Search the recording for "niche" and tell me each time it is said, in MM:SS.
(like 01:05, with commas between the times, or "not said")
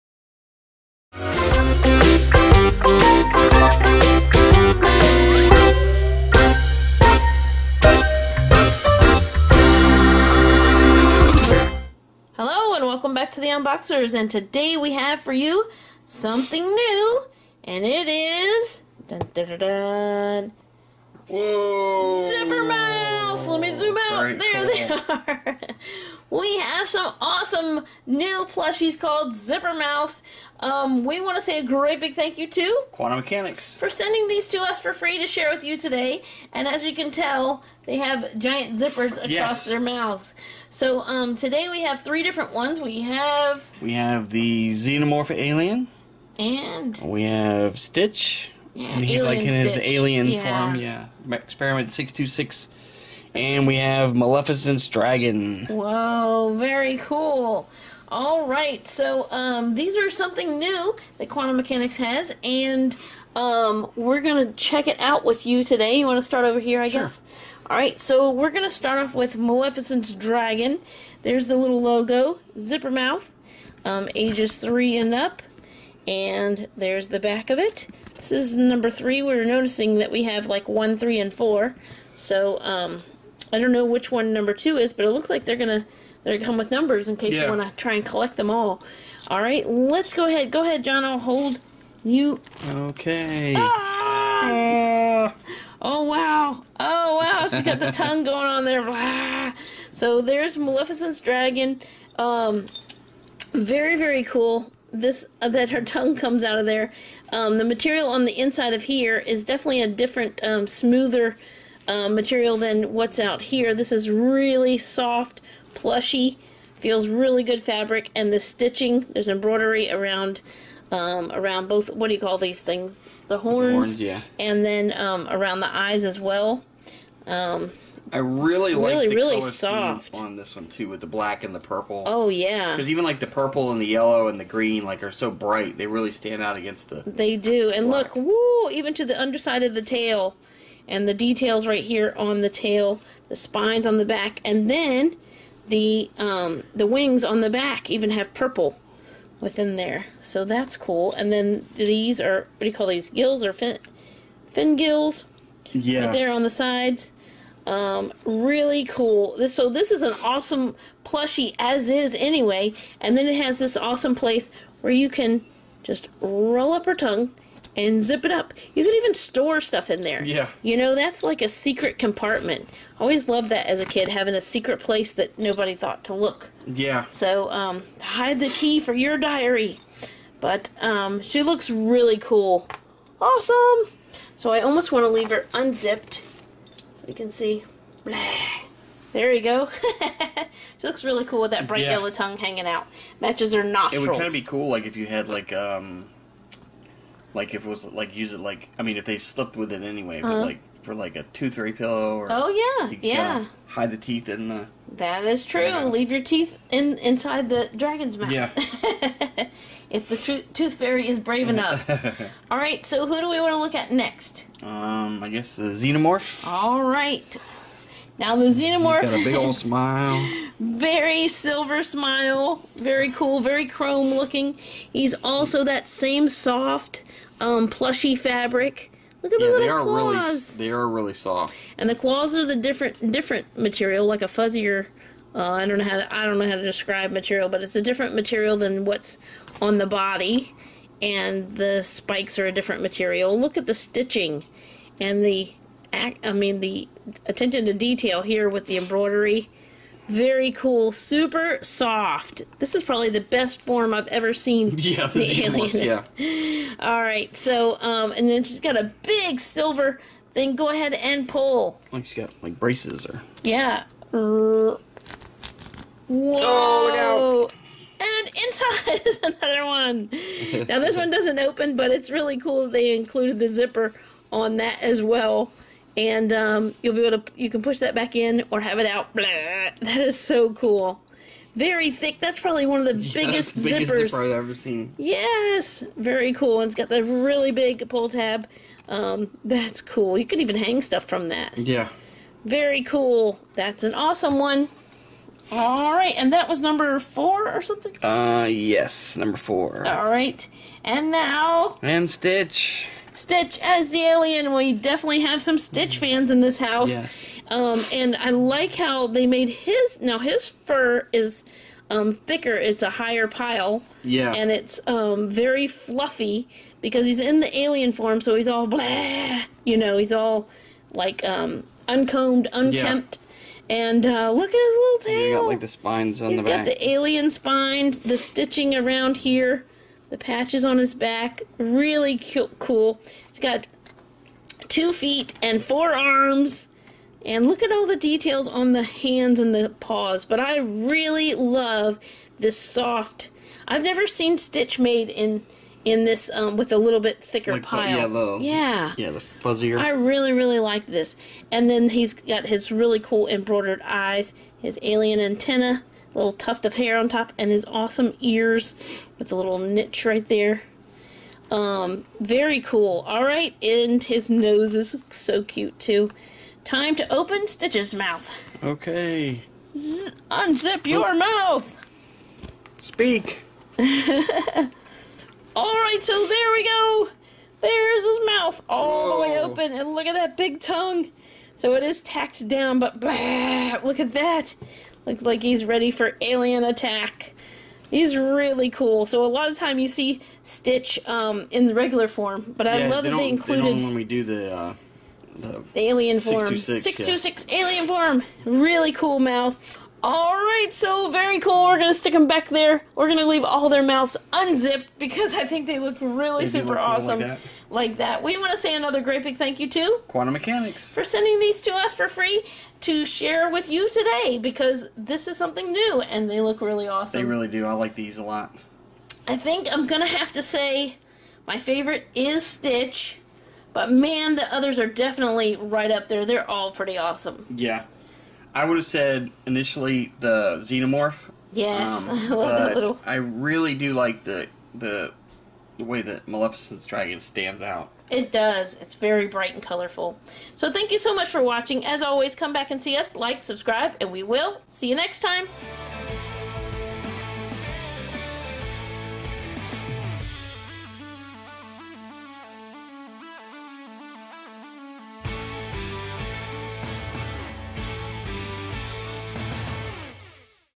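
05:59.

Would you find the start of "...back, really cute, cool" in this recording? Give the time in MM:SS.
05:30.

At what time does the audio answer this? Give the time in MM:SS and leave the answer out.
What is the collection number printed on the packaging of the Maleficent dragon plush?
01:18.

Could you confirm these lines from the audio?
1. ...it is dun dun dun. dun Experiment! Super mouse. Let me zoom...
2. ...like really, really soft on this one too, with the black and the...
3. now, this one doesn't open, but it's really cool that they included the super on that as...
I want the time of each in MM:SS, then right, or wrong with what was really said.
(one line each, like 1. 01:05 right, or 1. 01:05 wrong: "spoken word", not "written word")
1. 00:17 wrong: "Whoa", not "Experiment"
2. 02:08 right
3. 04:30 wrong: "zipper", not "super".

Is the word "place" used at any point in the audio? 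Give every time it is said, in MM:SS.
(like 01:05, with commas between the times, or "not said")
02:44, 02:54.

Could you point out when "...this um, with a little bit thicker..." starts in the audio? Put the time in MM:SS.
05:46.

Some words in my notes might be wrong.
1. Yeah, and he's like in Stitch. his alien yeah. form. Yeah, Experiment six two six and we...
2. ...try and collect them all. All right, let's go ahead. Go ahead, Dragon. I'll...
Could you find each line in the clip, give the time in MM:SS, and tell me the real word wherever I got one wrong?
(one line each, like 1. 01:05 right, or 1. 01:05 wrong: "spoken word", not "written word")
1. 00:48 right
2. 01:27 wrong: "John", not "Dragon".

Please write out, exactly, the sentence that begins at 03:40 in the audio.
Very silver smile, very cool, very chrome looking.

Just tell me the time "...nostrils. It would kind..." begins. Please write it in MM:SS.
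03:13.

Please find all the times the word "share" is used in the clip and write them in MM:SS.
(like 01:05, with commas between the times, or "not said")
00:35, 06:53.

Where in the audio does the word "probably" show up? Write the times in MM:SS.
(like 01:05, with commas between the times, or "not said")
04:12, 04:42.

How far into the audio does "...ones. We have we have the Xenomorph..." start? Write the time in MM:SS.
00:42.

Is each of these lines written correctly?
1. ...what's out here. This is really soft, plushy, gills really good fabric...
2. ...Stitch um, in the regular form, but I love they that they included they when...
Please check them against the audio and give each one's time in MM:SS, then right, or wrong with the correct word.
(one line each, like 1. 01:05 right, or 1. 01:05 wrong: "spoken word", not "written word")
1. 01:52 wrong: "feels", not "gills"
2. 06:30 right.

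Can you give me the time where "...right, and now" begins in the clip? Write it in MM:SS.
05:00.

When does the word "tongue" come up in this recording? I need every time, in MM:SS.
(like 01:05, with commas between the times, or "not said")
01:37, 01:45, 02:46, 03:12, 06:20.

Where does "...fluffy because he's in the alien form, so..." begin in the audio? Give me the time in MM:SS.
05:15.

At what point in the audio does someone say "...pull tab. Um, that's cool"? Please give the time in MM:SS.
04:47.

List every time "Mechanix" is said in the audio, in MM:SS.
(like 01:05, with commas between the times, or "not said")
00:33, 01:01, 06:50.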